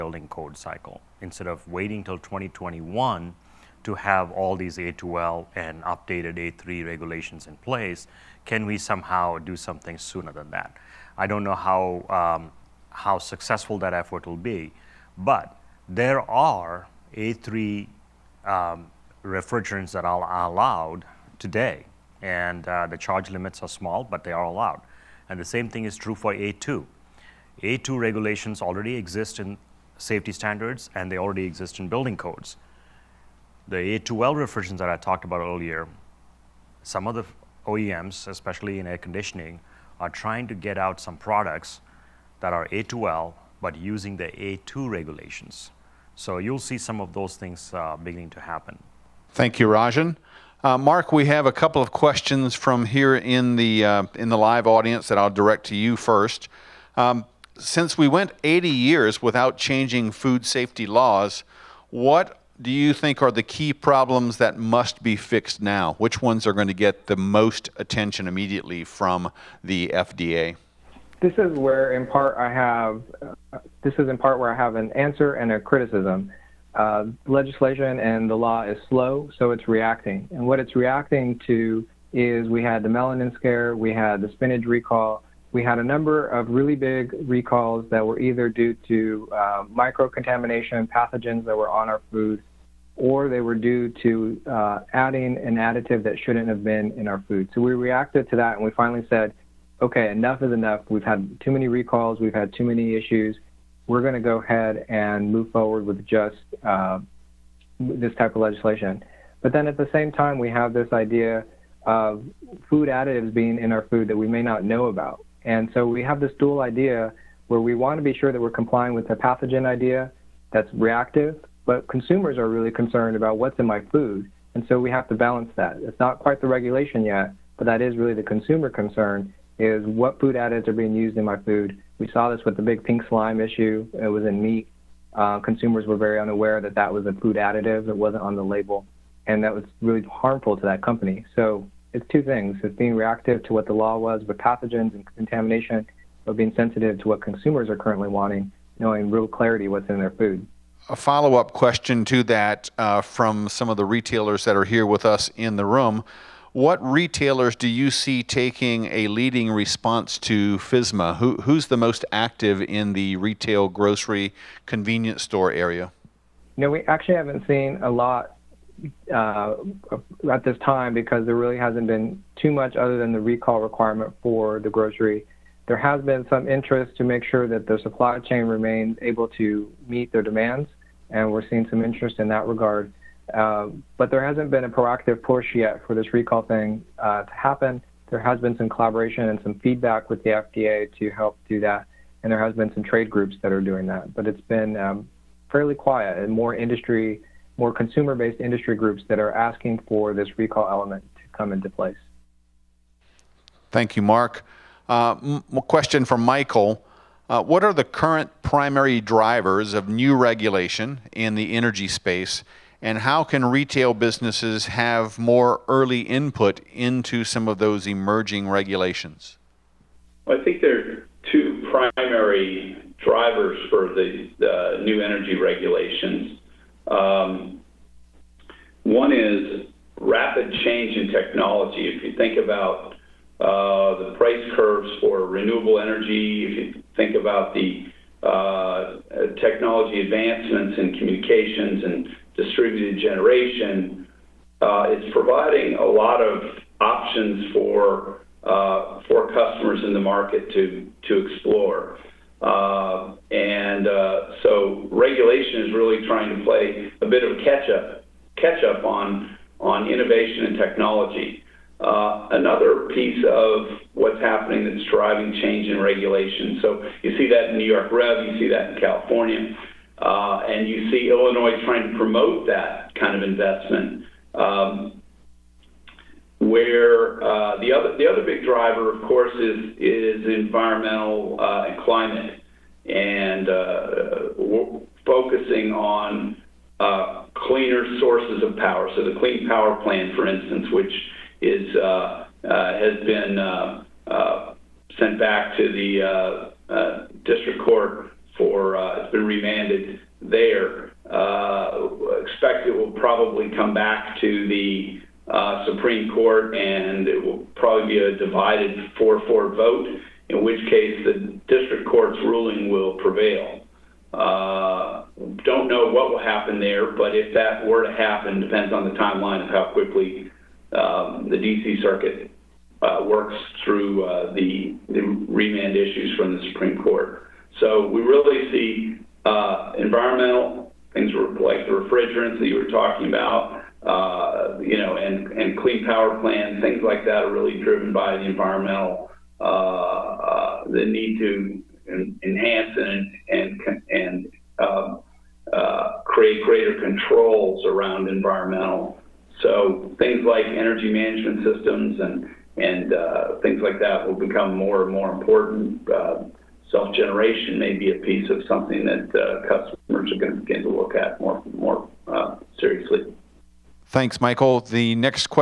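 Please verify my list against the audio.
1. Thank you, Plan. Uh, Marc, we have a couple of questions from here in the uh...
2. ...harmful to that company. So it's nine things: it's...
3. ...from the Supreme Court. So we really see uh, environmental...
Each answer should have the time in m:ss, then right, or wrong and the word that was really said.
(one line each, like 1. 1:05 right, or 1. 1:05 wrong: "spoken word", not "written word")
1. 0:49 wrong: "Rajan", not "Plan"
2. 2:20 wrong: "two", not "nine"
3. 5:26 right.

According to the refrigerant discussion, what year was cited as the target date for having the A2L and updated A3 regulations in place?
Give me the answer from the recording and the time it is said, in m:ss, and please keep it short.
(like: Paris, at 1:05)
2021, at 0:02.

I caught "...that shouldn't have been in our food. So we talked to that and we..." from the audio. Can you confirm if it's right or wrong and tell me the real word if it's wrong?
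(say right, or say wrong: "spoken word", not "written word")
wrong: "reacted", not "talked".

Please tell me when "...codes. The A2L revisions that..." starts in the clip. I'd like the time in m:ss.
0:32.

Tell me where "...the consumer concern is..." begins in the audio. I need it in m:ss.
2:08.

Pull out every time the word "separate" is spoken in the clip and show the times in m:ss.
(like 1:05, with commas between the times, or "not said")
not said.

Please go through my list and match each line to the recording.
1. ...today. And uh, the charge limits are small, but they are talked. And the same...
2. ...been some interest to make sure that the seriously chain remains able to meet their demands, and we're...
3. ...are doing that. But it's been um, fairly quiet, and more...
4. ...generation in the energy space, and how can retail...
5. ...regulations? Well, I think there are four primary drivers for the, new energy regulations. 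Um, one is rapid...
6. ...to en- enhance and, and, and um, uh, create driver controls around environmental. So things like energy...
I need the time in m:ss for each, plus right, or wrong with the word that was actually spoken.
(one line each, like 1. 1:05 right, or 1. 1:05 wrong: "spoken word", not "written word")
1. 0:21 wrong: "allowed", not "talked"
2. 2:56 wrong: "supply", not "seriously"
3. 3:13 right
4. 3:30 wrong: "regulation", not "generation"
5. 3:38 wrong: "two", not "four"
6. 5:41 wrong: "greater", not "driver".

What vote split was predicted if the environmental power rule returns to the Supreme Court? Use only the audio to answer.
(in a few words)
4-4.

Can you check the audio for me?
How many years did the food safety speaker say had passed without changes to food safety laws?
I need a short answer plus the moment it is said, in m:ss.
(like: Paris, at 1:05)
80 years, at 0:58.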